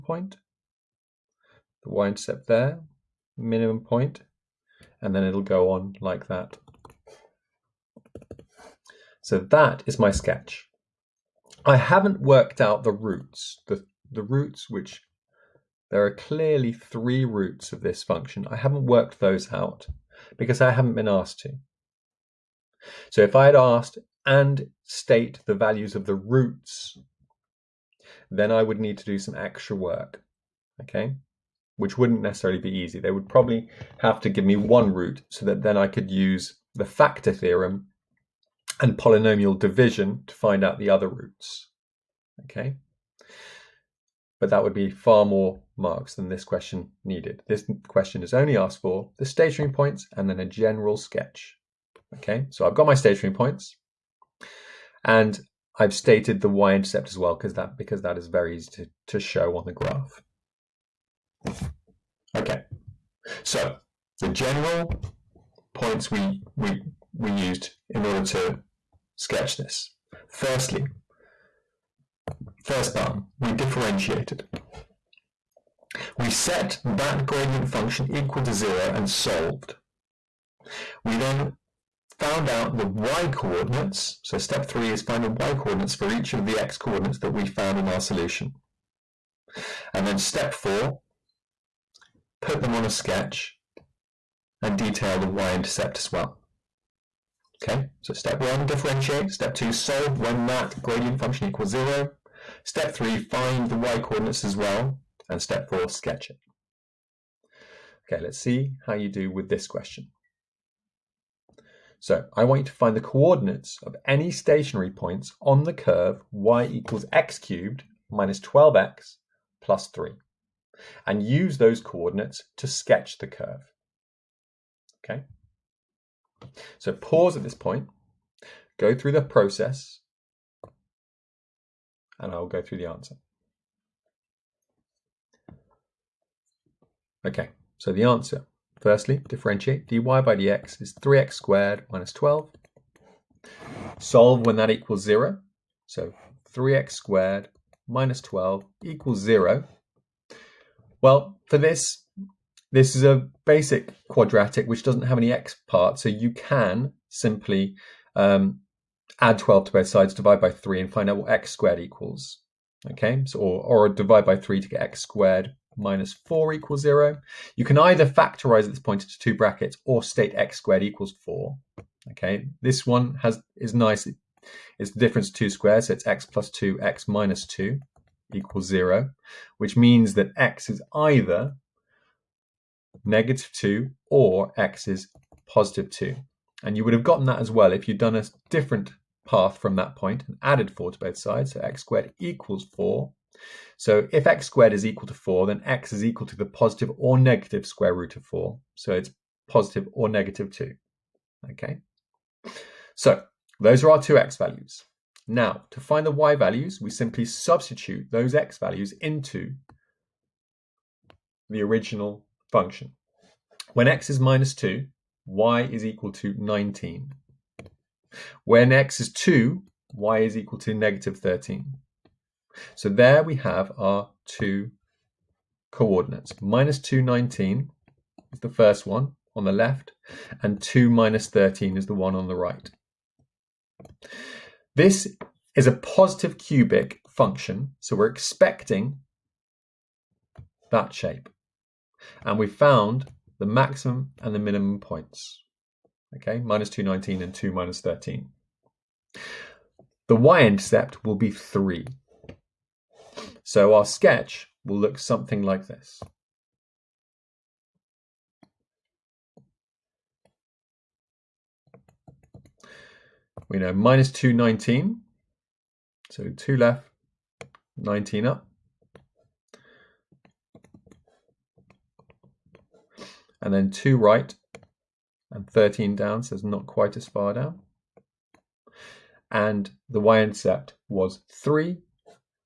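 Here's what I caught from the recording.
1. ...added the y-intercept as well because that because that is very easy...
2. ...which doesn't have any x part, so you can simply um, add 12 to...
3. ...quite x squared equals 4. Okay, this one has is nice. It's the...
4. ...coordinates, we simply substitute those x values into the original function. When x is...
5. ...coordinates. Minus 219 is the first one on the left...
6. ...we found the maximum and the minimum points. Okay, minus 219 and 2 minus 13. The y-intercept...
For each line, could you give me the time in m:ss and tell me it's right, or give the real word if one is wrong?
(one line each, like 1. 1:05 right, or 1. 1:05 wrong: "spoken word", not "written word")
1. 0:55 wrong: "stated", not "added"
2. 2:34 right
3. 2:50 wrong: "state", not "quite"
4. 3:26 wrong: "values", not "coordinates"
5. 3:45 right
6. 4:02 right.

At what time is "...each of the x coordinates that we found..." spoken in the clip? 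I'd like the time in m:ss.
1:26.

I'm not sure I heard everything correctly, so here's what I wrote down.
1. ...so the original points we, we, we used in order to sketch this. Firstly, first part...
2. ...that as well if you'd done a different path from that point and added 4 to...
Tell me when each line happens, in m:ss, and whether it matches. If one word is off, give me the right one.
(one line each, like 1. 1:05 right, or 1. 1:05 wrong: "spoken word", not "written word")
1. 1:03 wrong: "general", not "original"
2. 3:07 right.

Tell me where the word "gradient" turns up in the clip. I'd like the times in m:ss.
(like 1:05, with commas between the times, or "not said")
1:17, 1:40.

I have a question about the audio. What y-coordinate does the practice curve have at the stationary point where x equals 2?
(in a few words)
-13.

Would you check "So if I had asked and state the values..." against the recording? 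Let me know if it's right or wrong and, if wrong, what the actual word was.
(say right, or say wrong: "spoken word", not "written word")
right.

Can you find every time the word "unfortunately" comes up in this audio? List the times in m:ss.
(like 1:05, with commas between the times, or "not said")
not said.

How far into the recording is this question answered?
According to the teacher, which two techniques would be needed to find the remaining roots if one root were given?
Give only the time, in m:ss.
0:36.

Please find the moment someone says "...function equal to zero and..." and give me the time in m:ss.
1:17.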